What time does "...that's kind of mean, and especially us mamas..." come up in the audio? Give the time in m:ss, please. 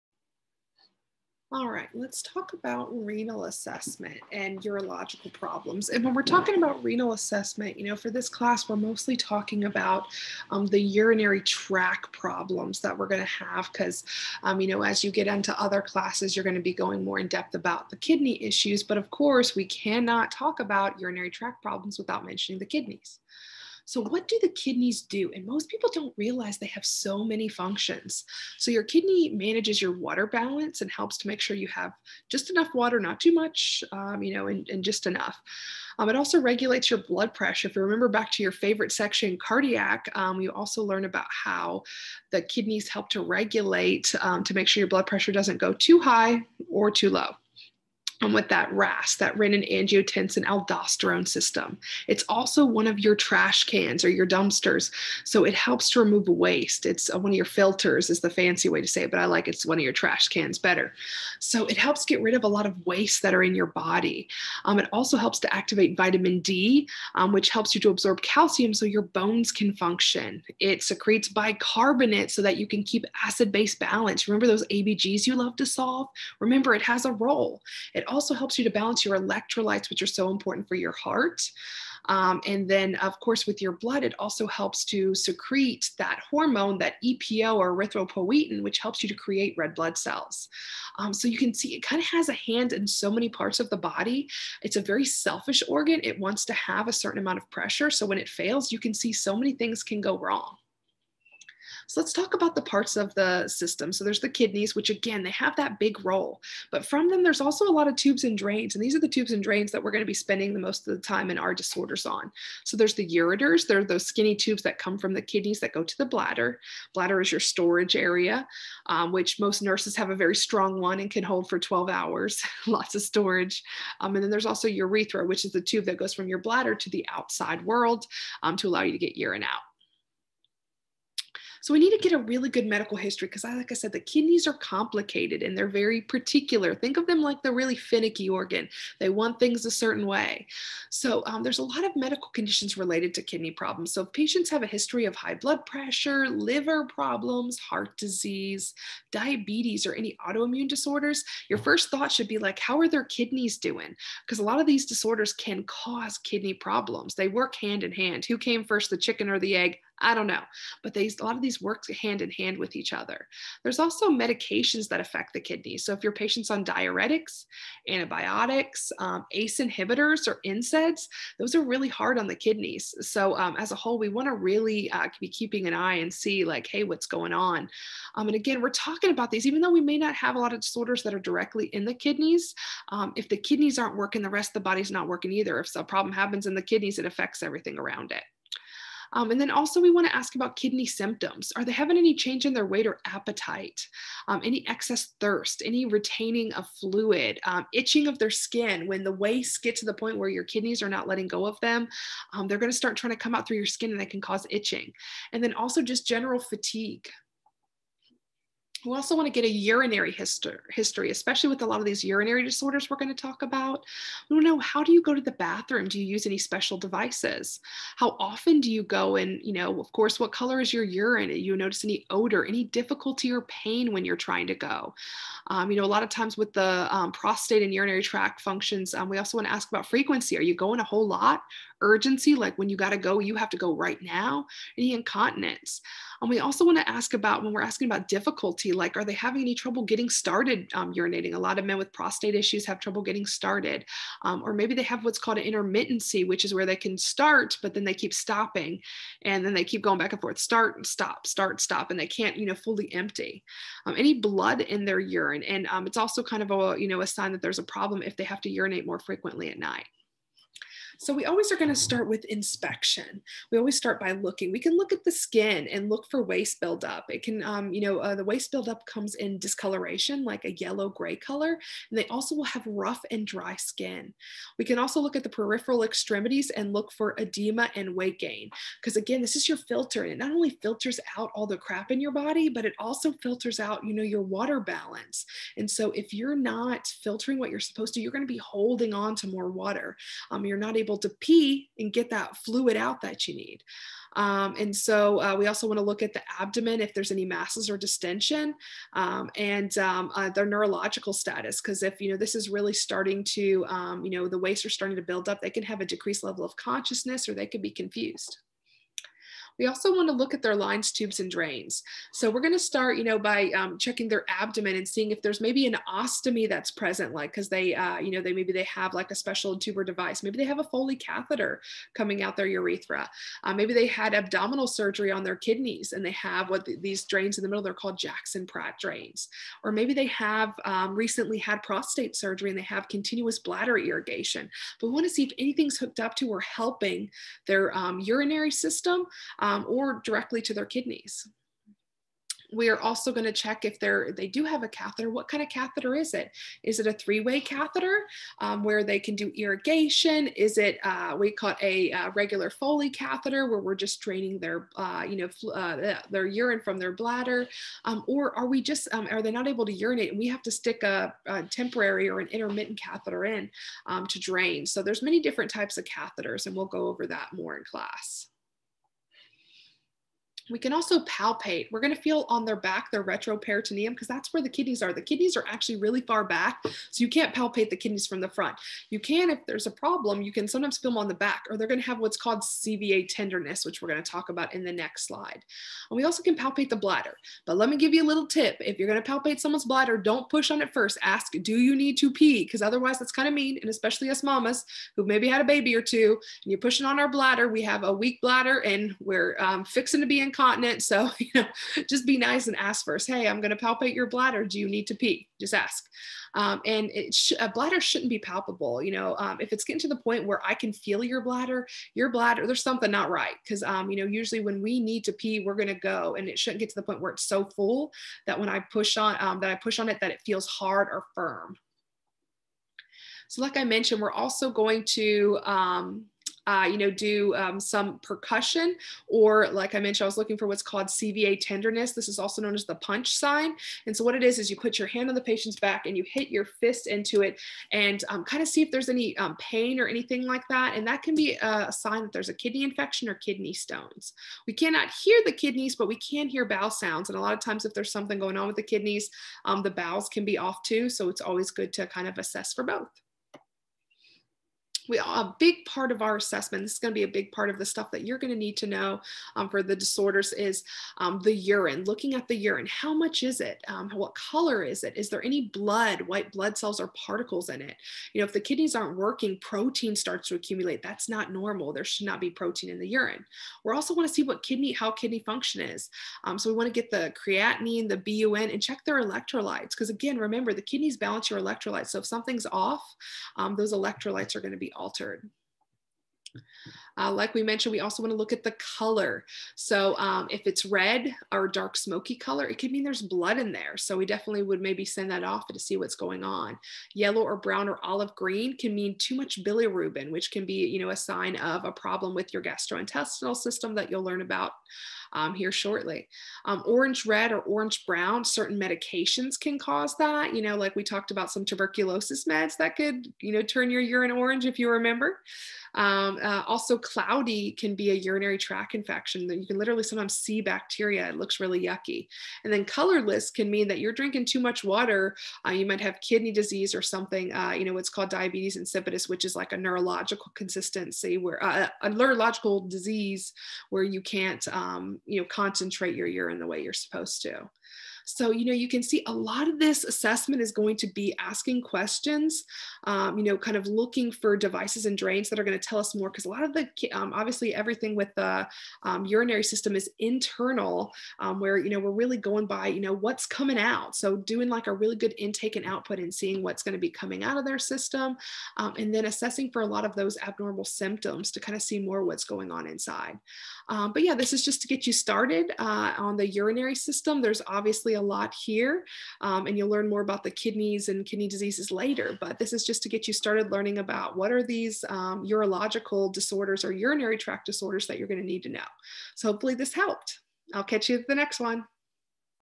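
6:32.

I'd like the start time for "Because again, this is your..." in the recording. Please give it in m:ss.
4:38.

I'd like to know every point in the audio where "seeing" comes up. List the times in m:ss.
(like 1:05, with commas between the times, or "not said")
5:14, 9:16.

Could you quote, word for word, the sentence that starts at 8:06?
Uh, like we mentioned, we also want to look at the color.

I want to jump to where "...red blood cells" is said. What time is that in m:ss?
1:29.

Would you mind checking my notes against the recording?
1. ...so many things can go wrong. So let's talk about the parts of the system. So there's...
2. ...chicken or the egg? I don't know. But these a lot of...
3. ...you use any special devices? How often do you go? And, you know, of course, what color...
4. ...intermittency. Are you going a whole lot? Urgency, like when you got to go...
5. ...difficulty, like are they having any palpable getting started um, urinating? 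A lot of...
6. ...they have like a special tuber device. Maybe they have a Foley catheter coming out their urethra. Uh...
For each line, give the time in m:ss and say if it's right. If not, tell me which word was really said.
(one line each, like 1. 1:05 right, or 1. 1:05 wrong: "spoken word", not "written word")
1. 1:39 right
2. 2:38 right
3. 3:35 right
4. 3:49 wrong: "frequency", not "intermittency"
5. 3:58 wrong: "trouble", not "palpable"
6. 5:18 right.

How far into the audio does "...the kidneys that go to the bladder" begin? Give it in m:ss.
1:55.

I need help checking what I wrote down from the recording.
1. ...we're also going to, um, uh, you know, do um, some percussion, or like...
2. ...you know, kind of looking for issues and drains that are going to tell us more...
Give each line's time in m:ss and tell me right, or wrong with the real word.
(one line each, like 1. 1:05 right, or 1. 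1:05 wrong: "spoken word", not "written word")
1. 7:04 right
2. 9:03 wrong: "devices", not "issues".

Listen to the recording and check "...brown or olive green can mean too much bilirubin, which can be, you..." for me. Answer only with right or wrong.
right.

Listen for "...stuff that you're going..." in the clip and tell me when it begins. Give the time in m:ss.
7:37.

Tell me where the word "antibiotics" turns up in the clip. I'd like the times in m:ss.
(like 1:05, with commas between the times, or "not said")
2:47.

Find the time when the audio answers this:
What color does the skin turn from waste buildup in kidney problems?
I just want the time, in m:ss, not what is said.
4:30.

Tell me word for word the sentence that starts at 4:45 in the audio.
And so if you're not filtering what you're supposed to, you're going to be holding on to more water.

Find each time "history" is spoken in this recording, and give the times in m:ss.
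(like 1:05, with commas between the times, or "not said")
2:12, 2:24, 3:30.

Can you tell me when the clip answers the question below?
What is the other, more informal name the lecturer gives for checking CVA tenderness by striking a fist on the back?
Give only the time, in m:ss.
7:12.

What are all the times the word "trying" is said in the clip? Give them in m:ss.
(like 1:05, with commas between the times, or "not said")
3:22, 3:44.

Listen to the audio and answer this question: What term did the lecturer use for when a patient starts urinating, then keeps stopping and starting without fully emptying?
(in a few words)
intermittency.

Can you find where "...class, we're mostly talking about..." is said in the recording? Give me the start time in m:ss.
0:08.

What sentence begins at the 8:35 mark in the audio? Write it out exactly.
Um, uh, also, cloudy can be a urinary tract infection that you can literally sometimes see bacteria.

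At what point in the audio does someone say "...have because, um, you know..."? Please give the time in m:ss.
0:13.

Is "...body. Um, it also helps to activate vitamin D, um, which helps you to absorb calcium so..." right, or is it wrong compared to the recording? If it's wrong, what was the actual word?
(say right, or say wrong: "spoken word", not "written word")
right.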